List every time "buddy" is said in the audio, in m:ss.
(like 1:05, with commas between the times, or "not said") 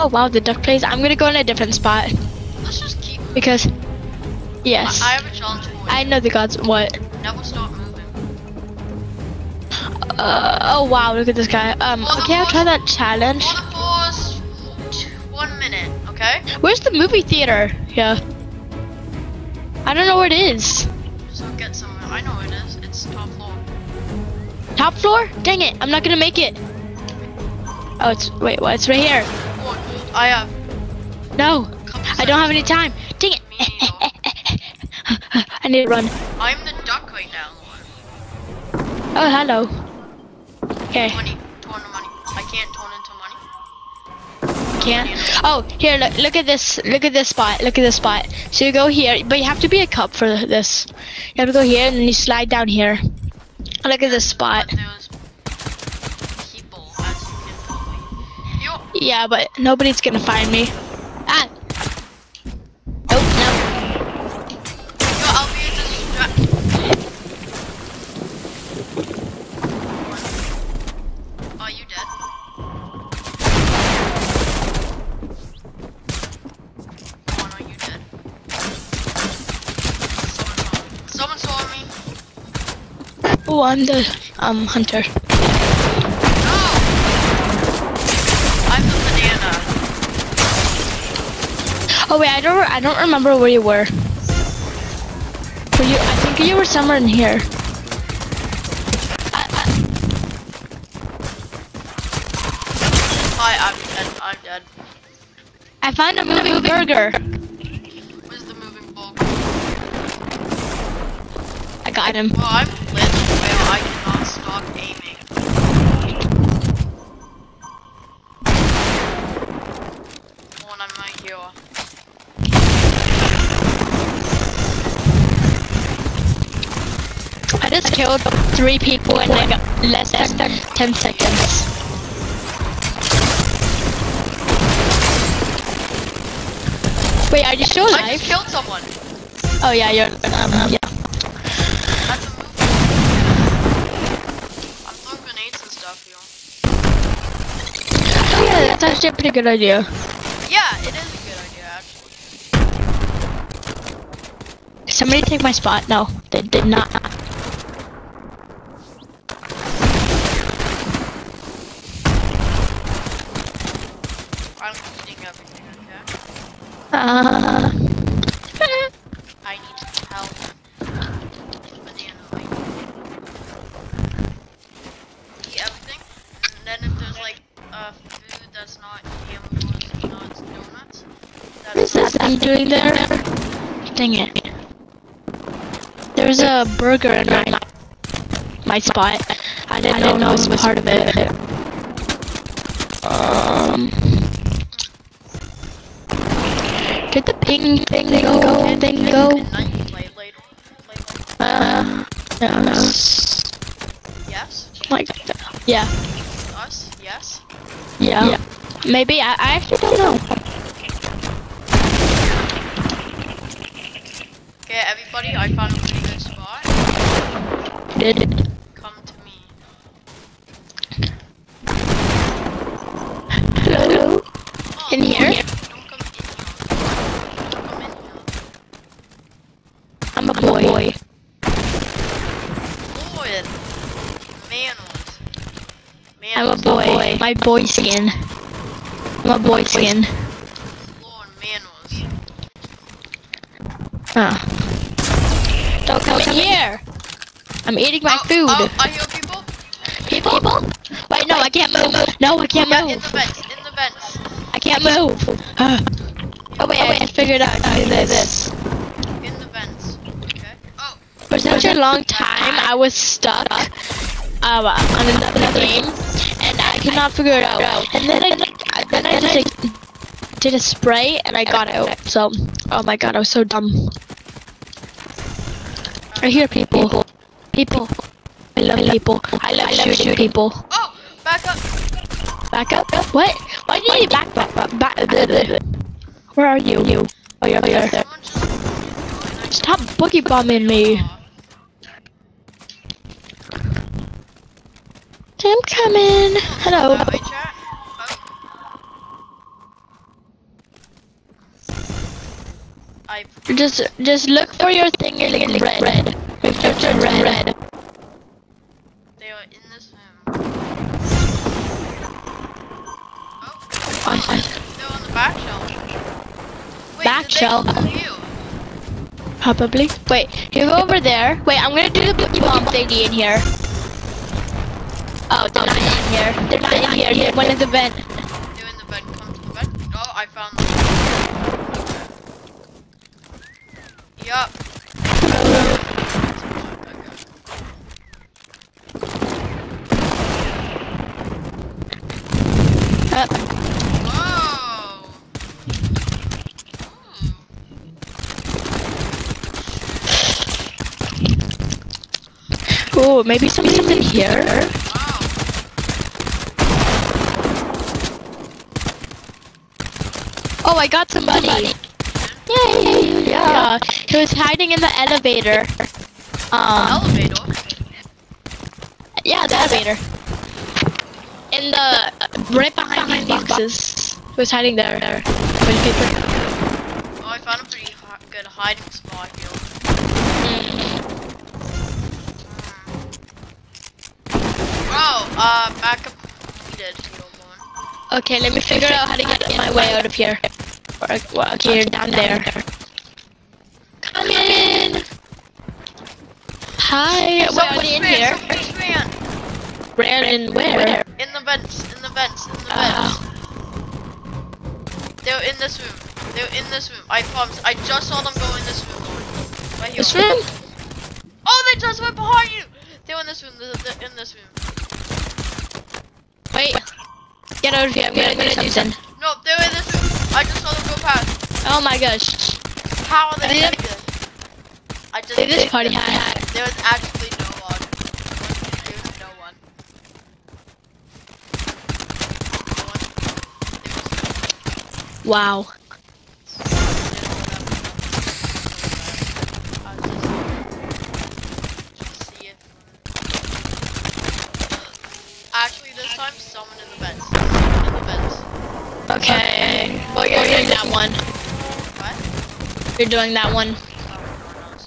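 3:35.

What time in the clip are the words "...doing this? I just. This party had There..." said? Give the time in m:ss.
7:03.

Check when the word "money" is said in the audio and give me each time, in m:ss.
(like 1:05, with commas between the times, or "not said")
0:43, 6:01.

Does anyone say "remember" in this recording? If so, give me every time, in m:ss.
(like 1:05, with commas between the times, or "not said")
1:32.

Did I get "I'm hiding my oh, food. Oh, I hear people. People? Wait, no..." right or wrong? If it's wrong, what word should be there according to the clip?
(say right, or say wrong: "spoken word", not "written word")
wrong: "eating", not "hiding".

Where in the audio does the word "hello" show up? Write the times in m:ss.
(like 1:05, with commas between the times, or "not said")
0:39, 3:43, 4:56.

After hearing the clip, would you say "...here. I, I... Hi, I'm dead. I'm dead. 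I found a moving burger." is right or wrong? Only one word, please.
right.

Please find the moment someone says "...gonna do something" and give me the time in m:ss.
6:58.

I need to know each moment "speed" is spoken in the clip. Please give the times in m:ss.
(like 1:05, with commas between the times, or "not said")
not said.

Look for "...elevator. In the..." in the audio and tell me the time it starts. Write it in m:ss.
6:09.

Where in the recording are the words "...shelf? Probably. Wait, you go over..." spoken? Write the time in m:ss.
5:17.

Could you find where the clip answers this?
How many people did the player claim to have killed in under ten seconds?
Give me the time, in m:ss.
2:08.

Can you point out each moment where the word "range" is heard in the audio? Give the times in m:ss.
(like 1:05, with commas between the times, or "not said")
not said.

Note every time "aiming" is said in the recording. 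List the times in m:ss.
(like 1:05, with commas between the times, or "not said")
1:54.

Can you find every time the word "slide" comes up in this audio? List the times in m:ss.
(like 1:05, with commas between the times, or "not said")
0:52.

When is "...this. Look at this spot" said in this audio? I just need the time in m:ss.
0:46.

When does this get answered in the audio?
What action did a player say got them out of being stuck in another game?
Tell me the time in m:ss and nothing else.
4:30.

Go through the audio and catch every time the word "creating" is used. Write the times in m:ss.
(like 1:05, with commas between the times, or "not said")
not said.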